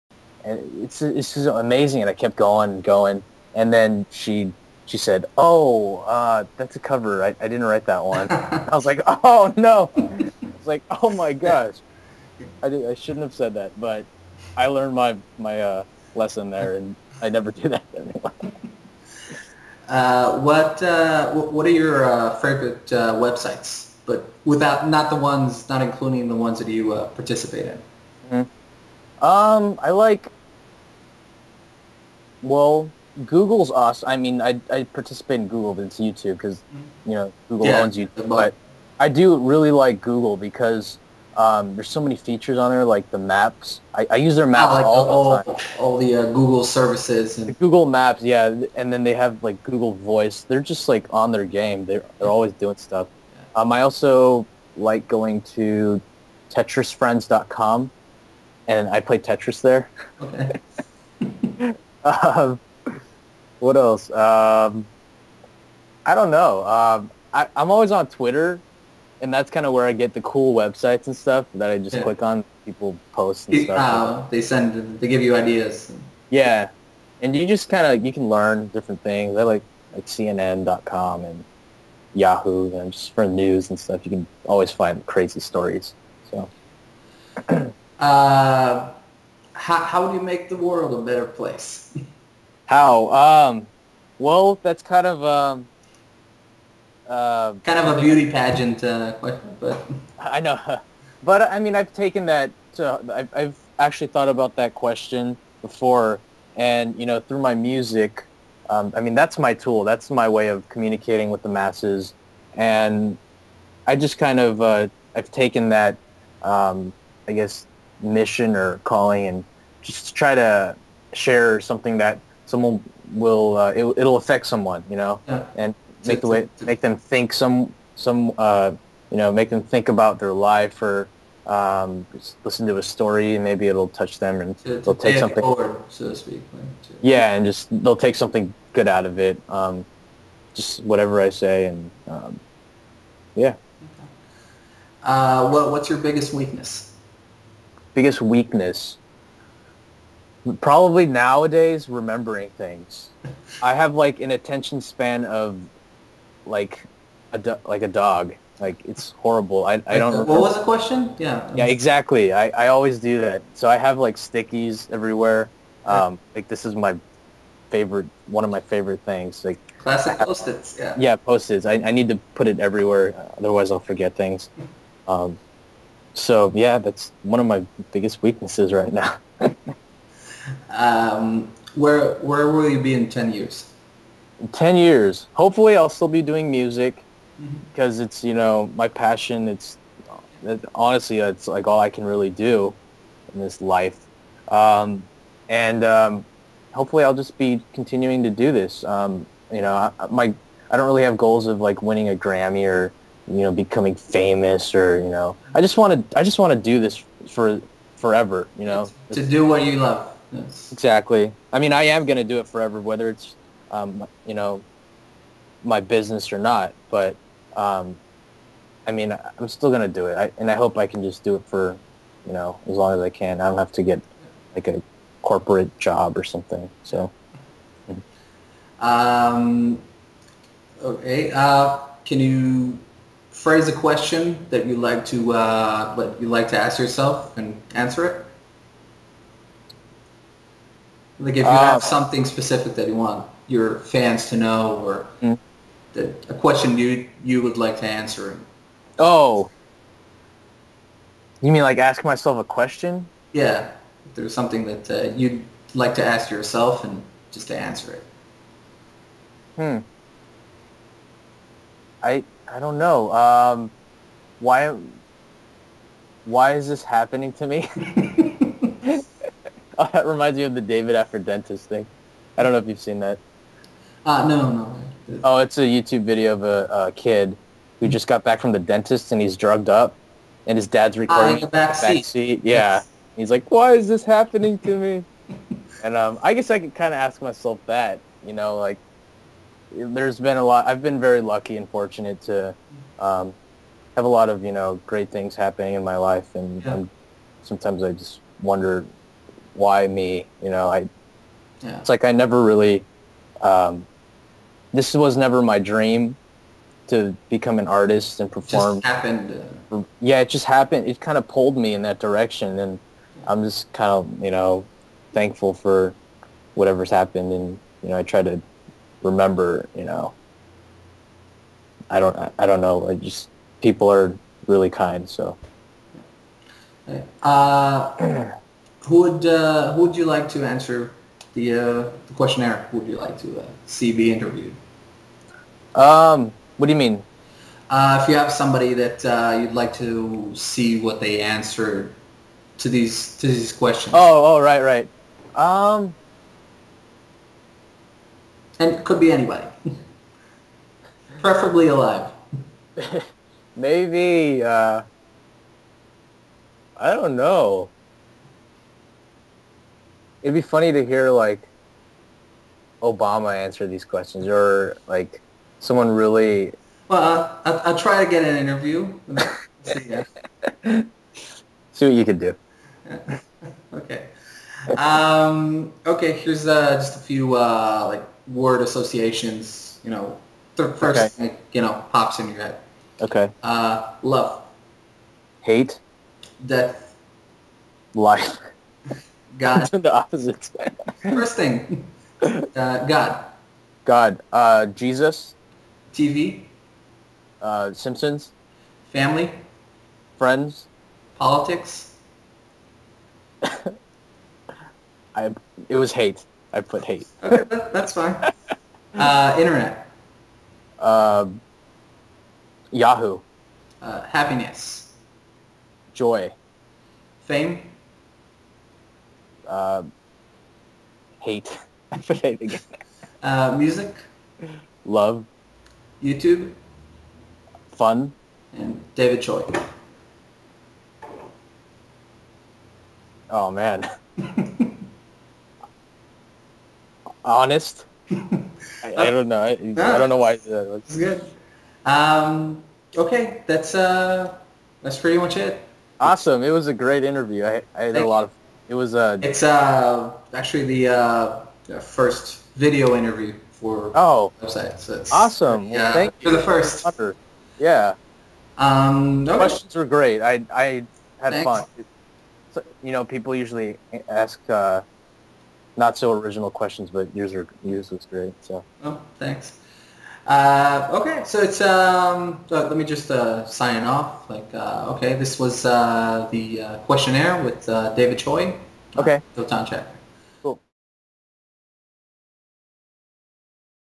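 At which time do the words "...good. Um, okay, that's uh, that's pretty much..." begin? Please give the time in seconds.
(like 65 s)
440 s.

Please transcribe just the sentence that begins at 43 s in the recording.
I, I use their maps ah, like all the, all, all the uh, Google services.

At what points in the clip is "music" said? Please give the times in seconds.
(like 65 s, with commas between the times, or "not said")
107 s, 186 s, 423 s.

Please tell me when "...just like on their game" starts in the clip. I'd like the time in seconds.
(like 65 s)
50 s.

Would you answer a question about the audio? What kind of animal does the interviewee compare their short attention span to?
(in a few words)
A dog.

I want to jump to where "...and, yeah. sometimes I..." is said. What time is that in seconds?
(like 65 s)
296 s.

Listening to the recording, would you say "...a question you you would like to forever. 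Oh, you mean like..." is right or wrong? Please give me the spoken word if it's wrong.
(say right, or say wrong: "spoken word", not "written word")
wrong: "answer", not "forever".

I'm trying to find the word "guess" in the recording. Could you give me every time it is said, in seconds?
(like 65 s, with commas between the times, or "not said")
117 s, 286 s.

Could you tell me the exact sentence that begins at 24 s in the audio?
But without not the ones, not including the ones that you uh, participate in.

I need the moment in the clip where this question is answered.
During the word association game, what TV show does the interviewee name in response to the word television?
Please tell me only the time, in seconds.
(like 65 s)
397 s.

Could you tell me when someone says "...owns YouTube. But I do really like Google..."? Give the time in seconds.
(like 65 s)
37 s.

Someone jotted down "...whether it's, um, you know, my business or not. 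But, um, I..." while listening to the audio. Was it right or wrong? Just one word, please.
right.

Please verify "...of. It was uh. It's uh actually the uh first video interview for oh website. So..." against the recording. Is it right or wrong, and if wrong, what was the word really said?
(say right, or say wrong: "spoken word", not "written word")
right.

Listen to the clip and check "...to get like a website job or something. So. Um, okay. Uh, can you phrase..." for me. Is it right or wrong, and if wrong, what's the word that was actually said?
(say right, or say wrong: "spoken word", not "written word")
wrong: "corporate", not "website".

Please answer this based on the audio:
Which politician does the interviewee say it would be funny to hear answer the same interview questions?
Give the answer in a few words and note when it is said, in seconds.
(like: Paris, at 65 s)
Obama, at 362 s.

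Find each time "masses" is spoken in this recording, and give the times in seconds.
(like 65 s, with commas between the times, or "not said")
111 s.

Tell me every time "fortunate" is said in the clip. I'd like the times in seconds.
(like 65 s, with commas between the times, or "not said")
291 s.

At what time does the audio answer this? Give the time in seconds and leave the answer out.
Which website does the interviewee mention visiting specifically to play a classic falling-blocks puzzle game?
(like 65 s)
56 s.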